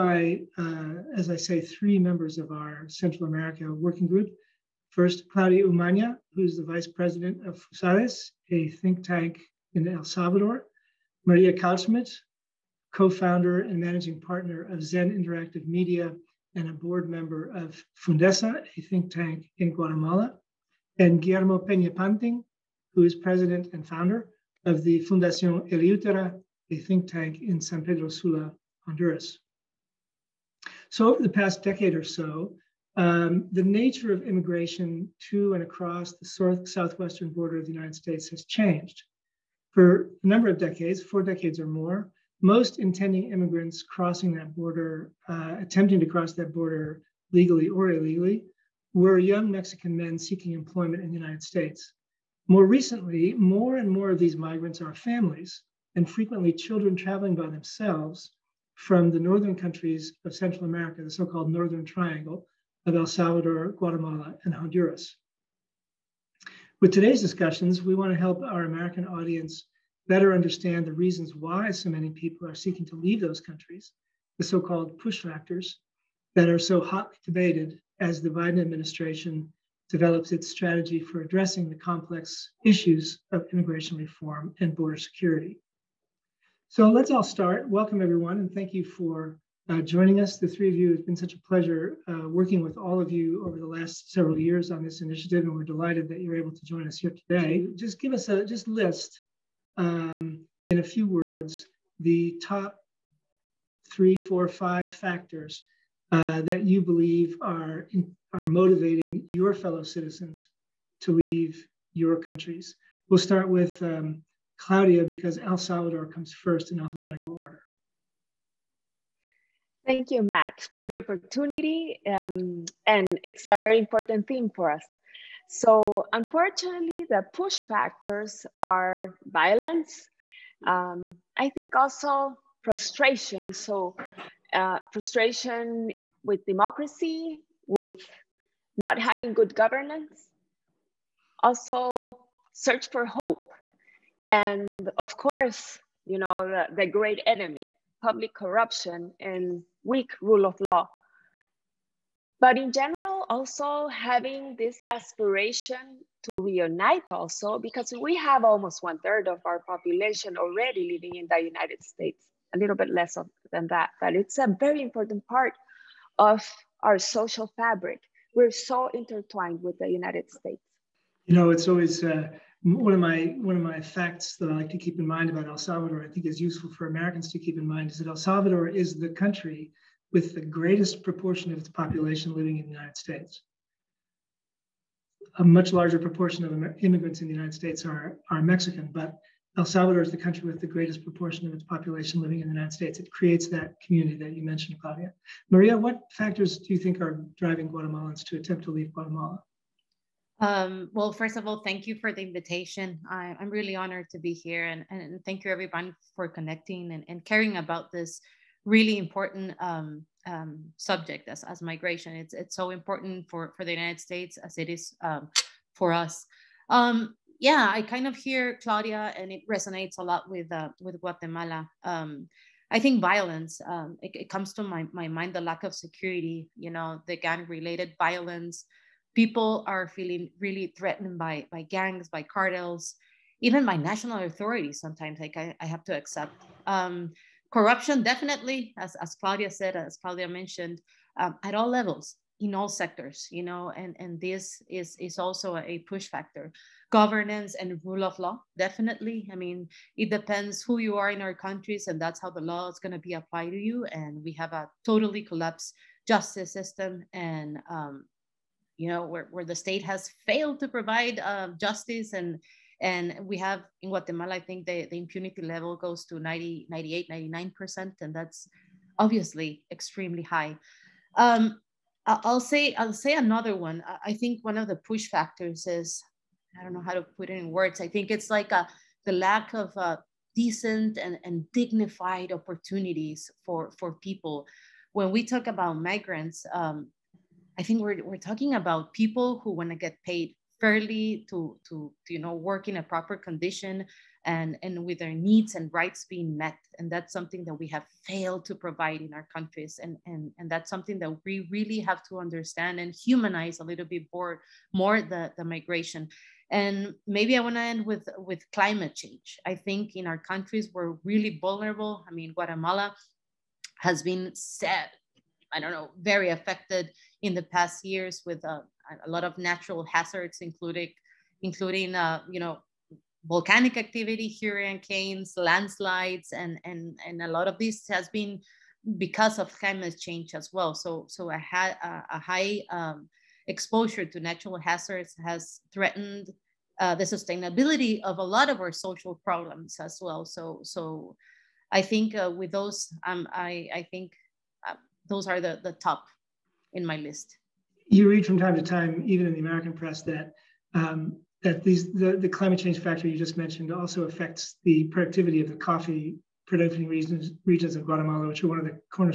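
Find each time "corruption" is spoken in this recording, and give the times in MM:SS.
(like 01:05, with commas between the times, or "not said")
02:28, 03:57.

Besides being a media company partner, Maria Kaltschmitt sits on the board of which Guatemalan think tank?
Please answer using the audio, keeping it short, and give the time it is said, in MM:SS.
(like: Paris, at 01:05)
Fundesa, at 00:18.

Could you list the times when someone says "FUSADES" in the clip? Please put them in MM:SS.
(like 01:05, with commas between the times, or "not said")
00:07.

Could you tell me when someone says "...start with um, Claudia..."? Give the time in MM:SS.
01:53.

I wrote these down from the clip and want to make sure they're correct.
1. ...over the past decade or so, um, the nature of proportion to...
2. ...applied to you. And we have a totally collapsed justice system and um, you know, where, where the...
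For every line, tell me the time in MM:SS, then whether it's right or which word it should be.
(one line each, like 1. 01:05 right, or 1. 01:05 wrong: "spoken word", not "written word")
1. 00:31 wrong: "immigration", not "proportion"
2. 04:13 right.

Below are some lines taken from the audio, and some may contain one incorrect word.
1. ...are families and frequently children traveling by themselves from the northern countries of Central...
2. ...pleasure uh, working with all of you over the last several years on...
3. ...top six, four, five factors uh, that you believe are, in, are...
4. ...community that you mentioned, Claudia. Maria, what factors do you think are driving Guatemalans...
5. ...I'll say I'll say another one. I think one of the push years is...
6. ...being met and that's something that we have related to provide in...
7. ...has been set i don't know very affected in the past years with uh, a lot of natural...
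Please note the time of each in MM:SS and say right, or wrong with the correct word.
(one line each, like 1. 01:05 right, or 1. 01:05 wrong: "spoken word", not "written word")
1. 00:54 right
2. 01:31 right
3. 01:42 wrong: "three", not "six"
4. 03:13 right
5. 04:32 wrong: "factors", not "years"
6. 04:56 wrong: "failed", not "related"
7. 05:13 right.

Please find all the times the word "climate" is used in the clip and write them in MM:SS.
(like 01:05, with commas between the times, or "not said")
05:08, 05:29, 05:52.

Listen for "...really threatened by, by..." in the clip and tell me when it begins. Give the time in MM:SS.
03:50.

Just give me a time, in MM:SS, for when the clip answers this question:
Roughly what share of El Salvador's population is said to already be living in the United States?
02:38.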